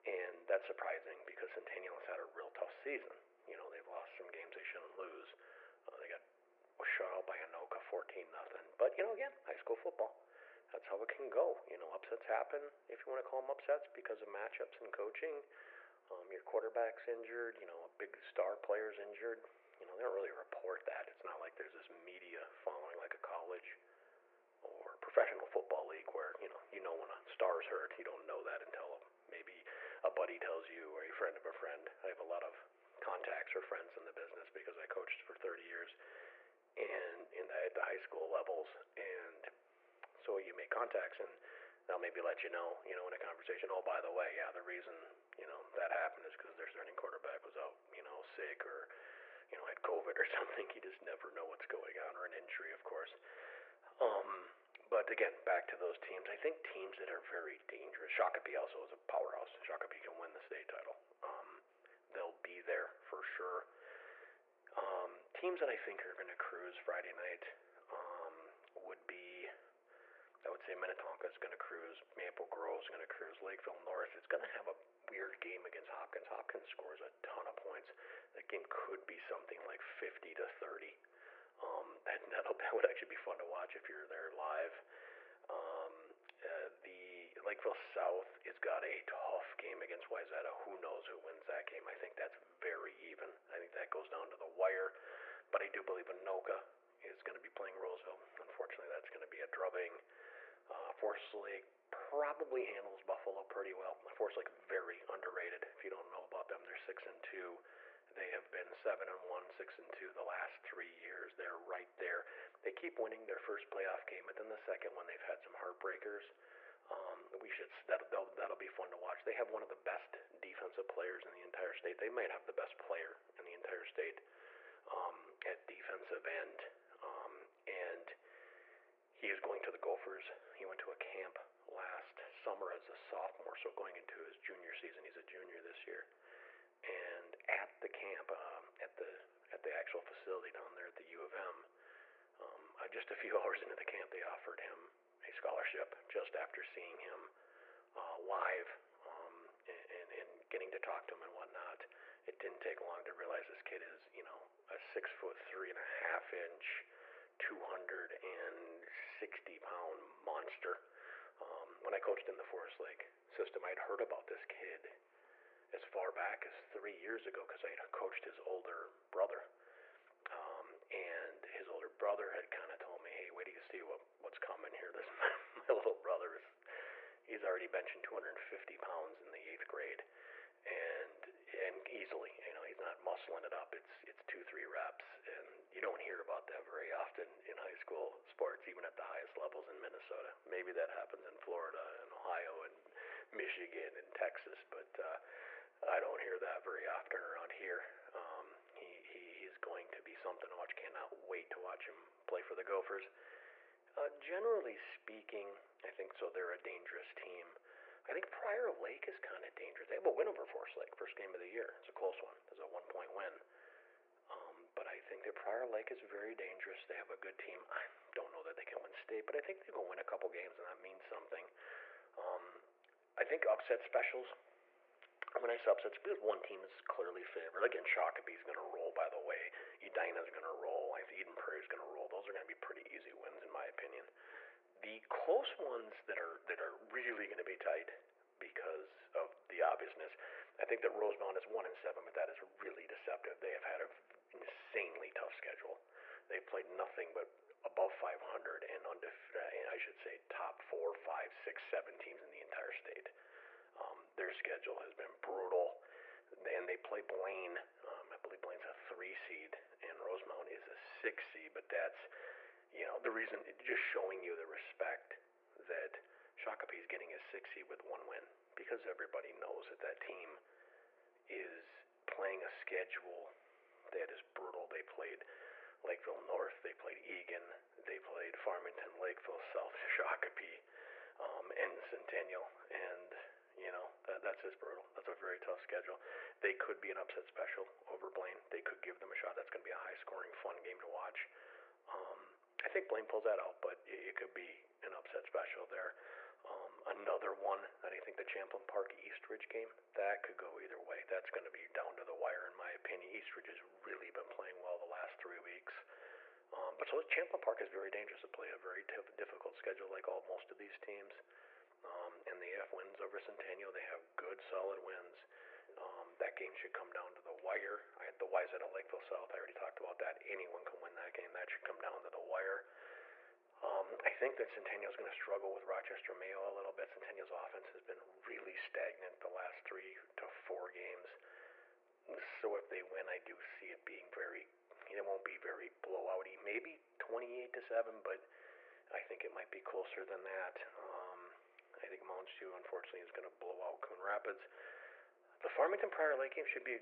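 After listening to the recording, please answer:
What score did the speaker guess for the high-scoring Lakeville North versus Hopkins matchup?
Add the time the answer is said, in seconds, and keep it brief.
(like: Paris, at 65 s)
50 to 30, at 79 s.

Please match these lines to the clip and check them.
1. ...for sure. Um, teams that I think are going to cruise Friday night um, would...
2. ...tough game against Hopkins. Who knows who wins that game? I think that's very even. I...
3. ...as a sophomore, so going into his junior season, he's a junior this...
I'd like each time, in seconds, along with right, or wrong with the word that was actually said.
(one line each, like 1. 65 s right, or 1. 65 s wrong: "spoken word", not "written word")
1. 63 s right
2. 89 s wrong: "Wayzata", not "Hopkins"
3. 132 s right.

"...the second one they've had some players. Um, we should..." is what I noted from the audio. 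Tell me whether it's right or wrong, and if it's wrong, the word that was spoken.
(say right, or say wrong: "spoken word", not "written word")
wrong: "heartbreakers", not "players".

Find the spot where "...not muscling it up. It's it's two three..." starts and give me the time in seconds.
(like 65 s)
182 s.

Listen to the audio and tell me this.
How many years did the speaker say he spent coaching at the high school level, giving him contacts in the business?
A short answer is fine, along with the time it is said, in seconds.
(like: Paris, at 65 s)
30, at 35 s.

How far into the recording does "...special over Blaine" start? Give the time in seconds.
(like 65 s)
287 s.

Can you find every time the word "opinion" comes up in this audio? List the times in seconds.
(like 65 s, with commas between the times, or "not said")
233 s, 302 s.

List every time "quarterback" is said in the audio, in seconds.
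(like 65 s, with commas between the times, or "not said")
16 s, 46 s.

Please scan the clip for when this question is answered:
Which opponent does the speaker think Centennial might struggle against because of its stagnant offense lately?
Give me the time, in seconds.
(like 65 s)
325 s.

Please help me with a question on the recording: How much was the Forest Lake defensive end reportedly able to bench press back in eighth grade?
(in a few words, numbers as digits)
250 pounds.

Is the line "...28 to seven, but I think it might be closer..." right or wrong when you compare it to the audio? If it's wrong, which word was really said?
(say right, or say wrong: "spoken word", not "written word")
right.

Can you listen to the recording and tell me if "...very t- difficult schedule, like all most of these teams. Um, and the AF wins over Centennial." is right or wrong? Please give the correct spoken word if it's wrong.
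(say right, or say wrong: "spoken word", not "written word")
right.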